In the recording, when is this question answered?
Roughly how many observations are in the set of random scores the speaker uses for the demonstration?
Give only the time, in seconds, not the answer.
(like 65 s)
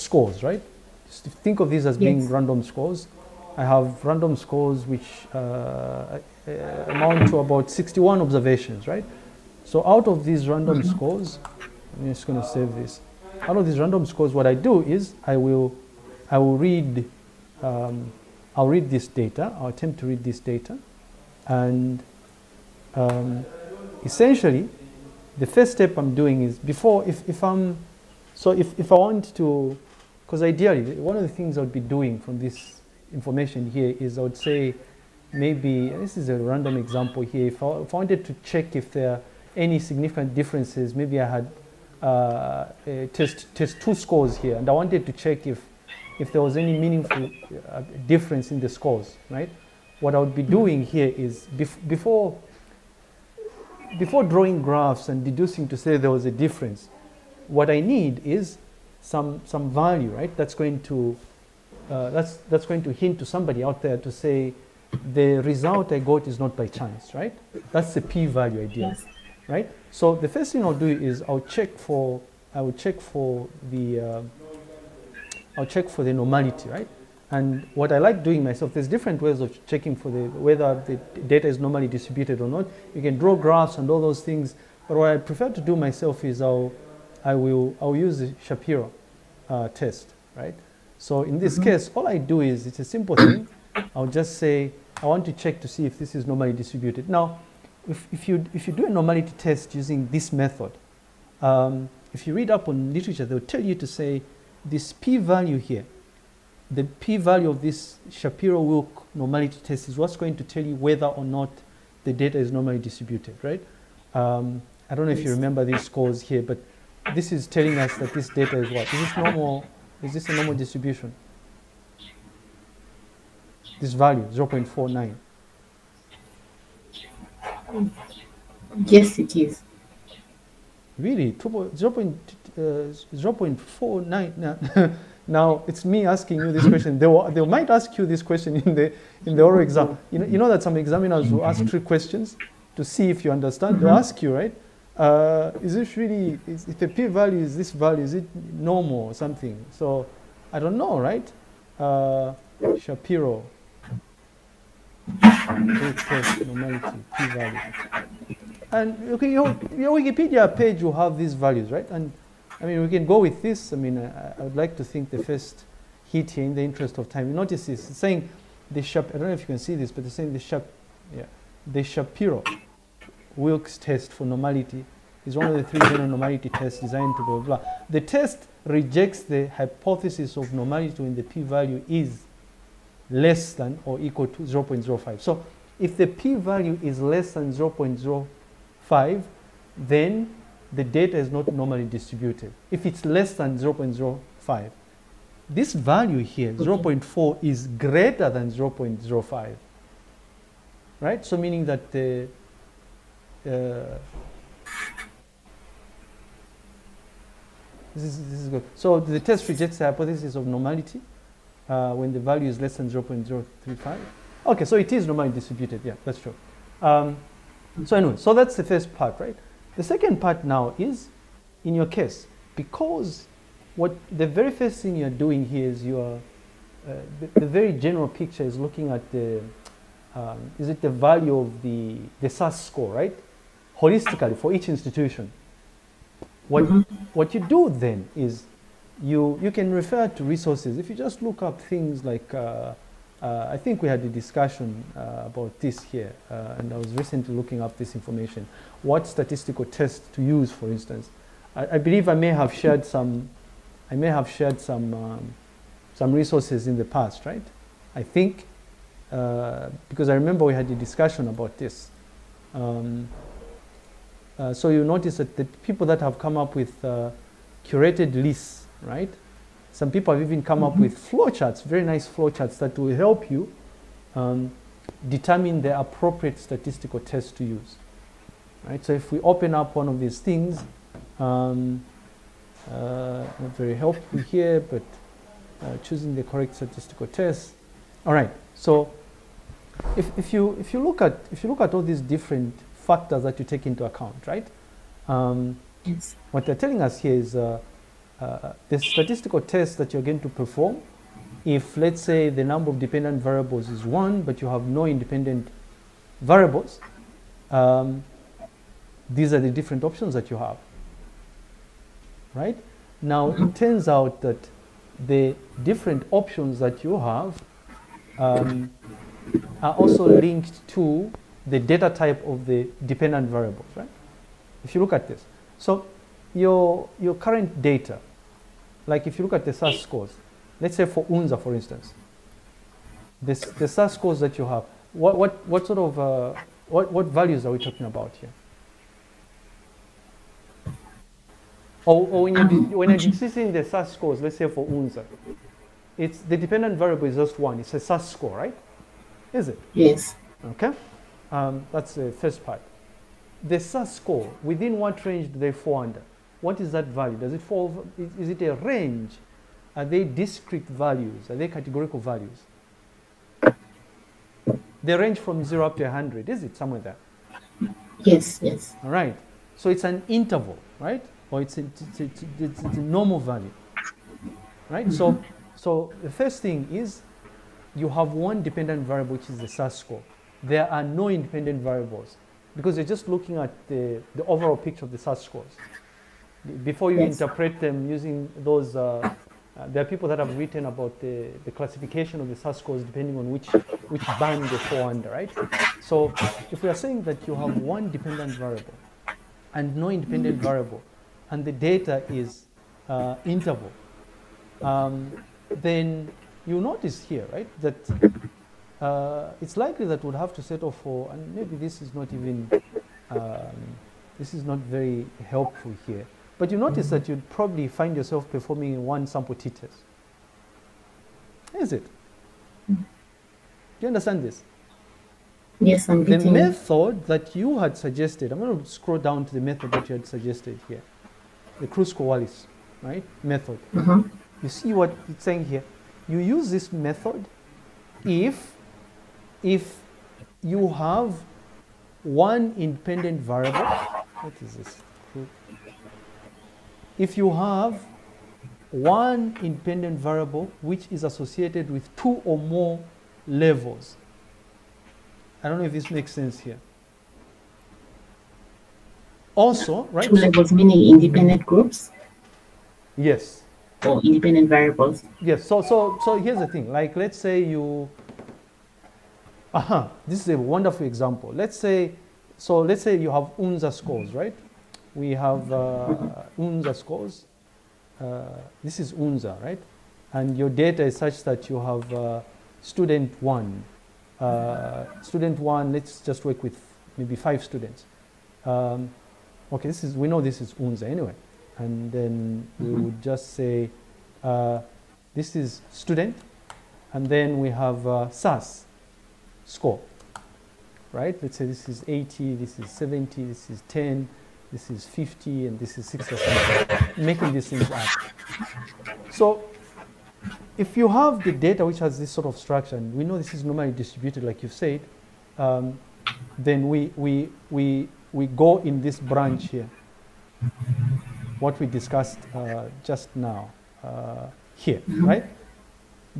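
7 s.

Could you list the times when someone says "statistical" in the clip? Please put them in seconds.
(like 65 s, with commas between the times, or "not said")
249 s, 276 s, 286 s, 298 s.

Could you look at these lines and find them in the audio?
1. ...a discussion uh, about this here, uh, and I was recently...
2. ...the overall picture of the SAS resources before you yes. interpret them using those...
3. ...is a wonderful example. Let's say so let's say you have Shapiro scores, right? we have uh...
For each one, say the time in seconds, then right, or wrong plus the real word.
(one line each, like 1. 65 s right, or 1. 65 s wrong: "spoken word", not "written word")
1. 244 s right
2. 384 s wrong: "scores", not "resources"
3. 470 s wrong: "UNSA", not "Shapiro".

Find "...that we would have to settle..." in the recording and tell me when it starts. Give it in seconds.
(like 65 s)
409 s.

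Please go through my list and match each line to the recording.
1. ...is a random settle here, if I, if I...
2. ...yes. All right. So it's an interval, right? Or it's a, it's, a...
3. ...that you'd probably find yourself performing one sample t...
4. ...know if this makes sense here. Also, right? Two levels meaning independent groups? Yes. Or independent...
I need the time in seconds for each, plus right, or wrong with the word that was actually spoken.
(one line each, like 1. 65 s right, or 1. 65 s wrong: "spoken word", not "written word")
1. 36 s wrong: "example", not "settle"
2. 368 s right
3. 416 s right
4. 455 s right.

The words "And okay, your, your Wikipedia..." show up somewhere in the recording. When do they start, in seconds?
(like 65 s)
158 s.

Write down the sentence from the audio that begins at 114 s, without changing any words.
Um, I don't know if you remember these scores here, but this is telling us that this data is what?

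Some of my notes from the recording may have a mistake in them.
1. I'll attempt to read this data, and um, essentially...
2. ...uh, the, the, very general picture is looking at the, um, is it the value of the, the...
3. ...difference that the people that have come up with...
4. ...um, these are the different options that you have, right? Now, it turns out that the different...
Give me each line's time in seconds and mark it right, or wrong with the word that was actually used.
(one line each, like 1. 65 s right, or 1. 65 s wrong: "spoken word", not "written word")
1. 19 s right
2. 226 s right
3. 264 s wrong: "notice", not "difference"
4. 307 s right.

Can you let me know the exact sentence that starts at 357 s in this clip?
Does it fall, is it a range?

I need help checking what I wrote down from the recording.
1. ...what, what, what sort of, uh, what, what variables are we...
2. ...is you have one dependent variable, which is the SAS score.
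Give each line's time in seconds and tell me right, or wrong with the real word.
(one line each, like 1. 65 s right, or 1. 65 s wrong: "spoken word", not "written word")
1. 334 s wrong: "values", not "variables"
2. 376 s right.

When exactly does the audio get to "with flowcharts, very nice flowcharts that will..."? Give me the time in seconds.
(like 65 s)
270 s.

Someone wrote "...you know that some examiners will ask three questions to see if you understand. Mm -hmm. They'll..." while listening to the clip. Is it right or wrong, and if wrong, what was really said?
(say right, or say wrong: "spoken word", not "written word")
right.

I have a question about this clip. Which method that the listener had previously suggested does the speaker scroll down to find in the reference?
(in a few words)
Kruskal-Wallis.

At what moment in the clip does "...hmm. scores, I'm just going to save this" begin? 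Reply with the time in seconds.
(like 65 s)
10 s.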